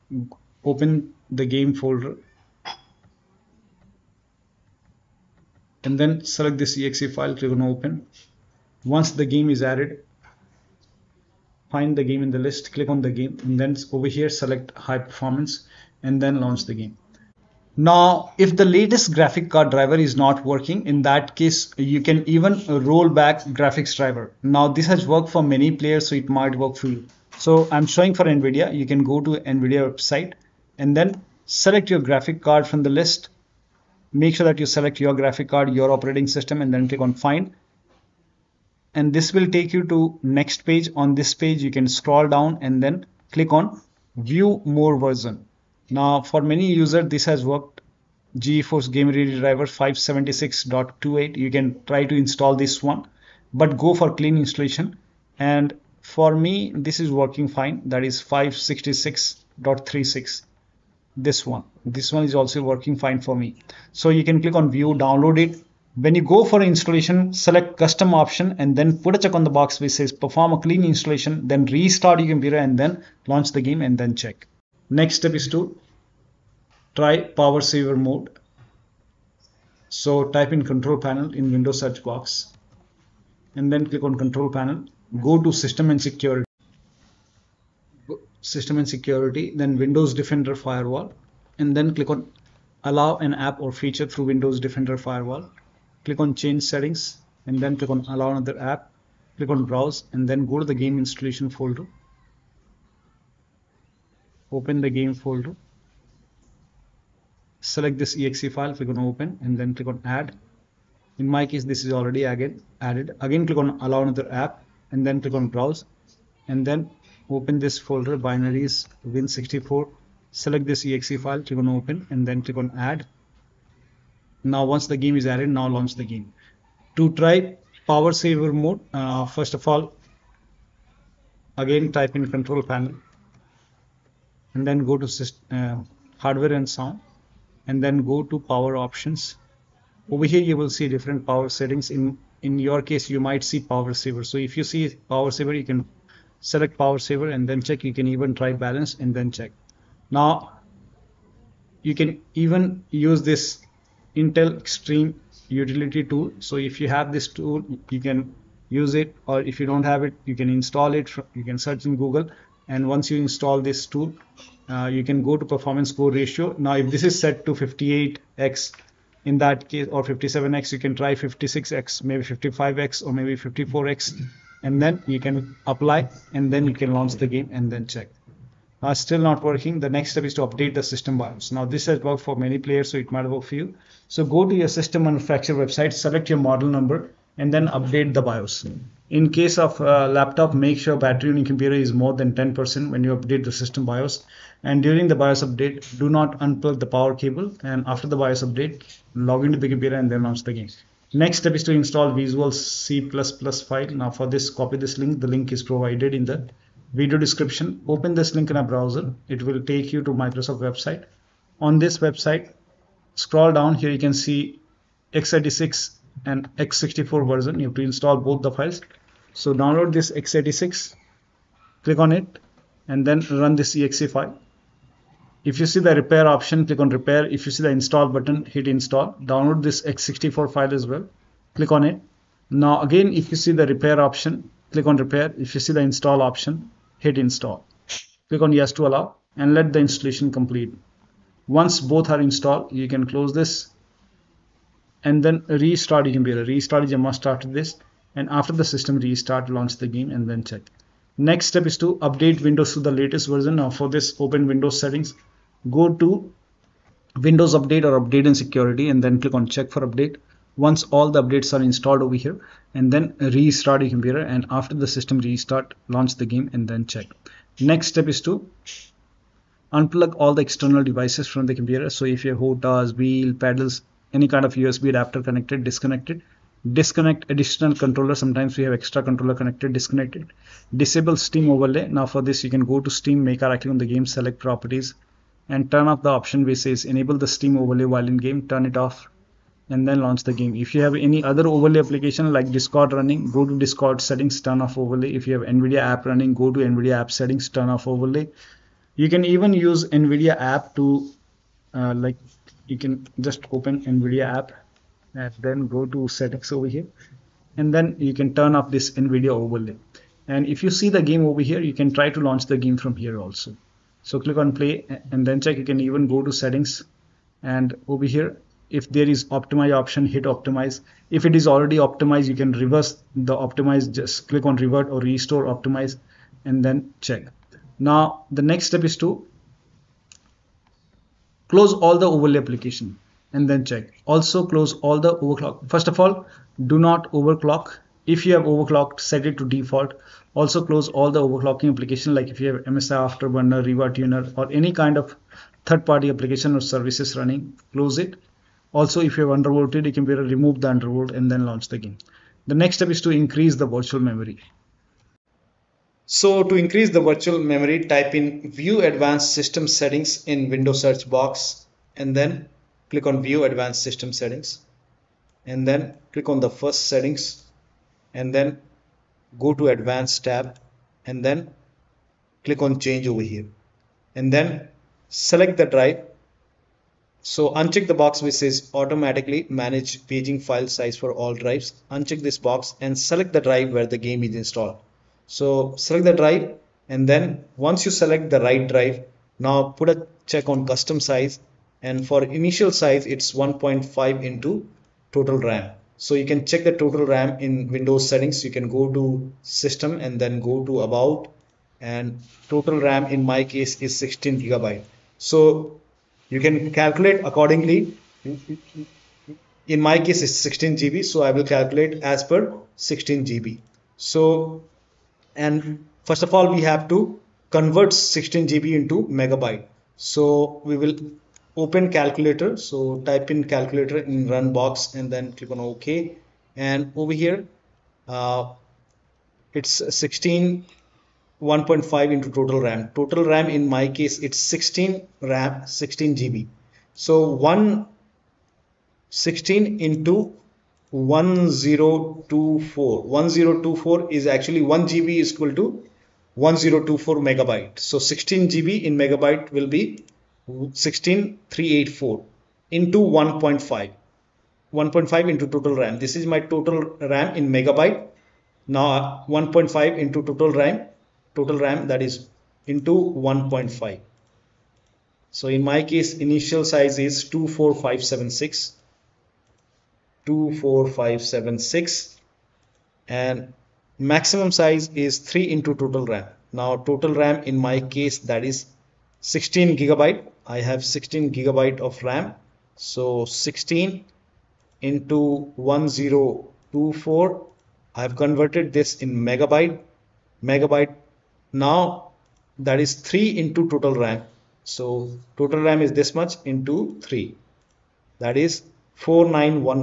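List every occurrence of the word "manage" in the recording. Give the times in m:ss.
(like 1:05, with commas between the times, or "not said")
6:19.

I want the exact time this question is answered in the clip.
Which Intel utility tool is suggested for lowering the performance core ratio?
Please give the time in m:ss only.
2:34.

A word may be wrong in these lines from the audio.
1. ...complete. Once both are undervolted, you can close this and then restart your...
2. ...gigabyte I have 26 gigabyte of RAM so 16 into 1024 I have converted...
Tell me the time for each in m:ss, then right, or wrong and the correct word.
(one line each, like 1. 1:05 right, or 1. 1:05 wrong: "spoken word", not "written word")
1. 4:00 wrong: "installed", not "undervolted"
2. 7:59 wrong: "16", not "26".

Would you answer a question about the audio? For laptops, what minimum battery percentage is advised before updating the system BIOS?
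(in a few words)
10%.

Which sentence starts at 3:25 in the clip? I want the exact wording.
The link is provided in the video description.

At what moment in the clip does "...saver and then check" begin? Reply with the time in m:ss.
2:26.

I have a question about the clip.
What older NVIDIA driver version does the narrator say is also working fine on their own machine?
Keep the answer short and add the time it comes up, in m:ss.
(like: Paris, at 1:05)
566.36, at 0:58.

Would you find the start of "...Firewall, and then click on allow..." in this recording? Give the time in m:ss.
1:30.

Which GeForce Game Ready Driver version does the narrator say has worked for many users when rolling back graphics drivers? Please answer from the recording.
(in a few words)
576.28.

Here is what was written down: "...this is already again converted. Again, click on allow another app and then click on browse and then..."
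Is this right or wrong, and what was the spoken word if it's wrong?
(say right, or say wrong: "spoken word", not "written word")
wrong: "added", not "converted".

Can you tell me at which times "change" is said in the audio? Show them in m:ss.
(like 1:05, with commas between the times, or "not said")
1:36, 6:12.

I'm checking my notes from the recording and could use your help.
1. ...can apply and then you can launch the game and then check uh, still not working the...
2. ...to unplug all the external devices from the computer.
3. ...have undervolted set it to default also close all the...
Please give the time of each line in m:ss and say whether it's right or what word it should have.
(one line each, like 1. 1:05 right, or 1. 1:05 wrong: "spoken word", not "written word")
1. 2:55 right
2. 4:28 right
3. 5:38 wrong: "overclocked", not "undervolted".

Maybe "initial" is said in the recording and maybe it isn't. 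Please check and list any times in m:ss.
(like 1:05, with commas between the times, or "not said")
6:32, 7:46.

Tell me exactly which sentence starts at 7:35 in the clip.
This is my total RAM in megabyte.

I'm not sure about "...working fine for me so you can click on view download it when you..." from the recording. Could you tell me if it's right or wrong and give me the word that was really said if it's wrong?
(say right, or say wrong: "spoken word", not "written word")
right.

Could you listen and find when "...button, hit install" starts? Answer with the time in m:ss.
3:48.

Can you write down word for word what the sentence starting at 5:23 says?
Just click on revert or restore optimize and then check.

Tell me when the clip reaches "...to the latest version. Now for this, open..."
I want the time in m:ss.
4:12.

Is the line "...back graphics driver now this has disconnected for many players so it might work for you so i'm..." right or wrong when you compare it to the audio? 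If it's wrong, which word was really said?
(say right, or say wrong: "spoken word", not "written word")
wrong: "worked", not "disconnected".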